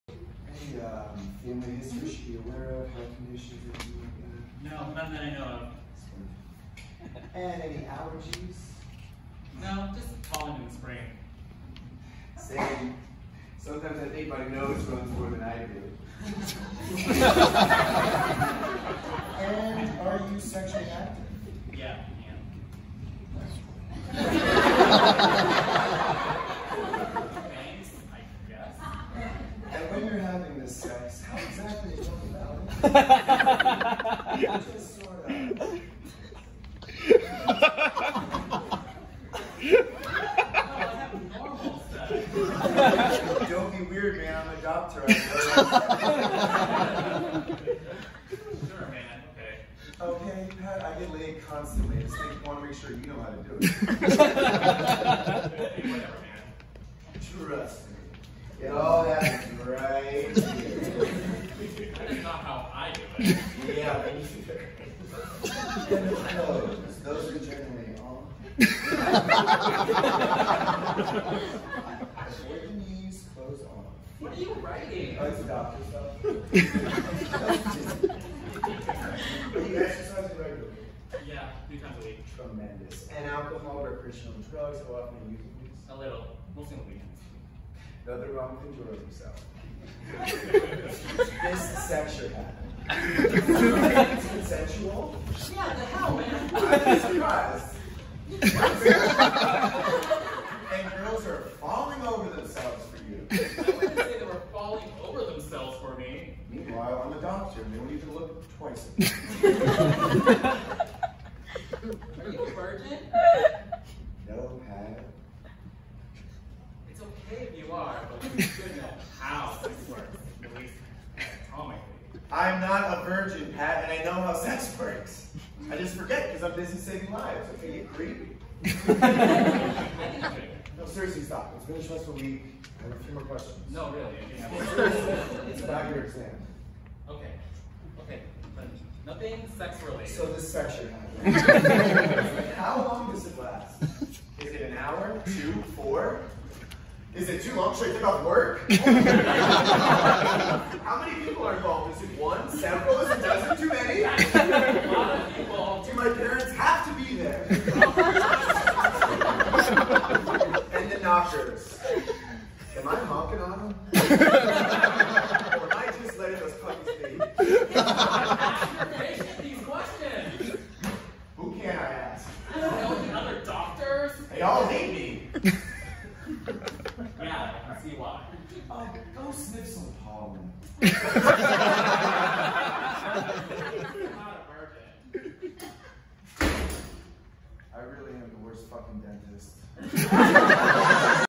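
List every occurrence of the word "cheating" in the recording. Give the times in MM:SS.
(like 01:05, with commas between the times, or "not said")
not said.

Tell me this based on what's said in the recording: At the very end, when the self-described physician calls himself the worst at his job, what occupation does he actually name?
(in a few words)
dentist.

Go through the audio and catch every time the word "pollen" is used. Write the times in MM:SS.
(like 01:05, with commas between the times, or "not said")
00:10, 03:00.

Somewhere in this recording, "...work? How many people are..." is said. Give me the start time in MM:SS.
02:28.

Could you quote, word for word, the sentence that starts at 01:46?
Meanwhile, I'm a doctor, and they do not even look twice Are you a virgin?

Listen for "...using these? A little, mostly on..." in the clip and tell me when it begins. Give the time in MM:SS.
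01:25.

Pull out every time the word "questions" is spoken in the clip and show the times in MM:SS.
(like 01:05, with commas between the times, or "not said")
02:13, 02:49.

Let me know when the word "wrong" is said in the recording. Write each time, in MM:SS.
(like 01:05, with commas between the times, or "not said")
01:28.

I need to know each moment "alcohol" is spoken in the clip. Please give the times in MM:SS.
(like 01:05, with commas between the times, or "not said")
01:23.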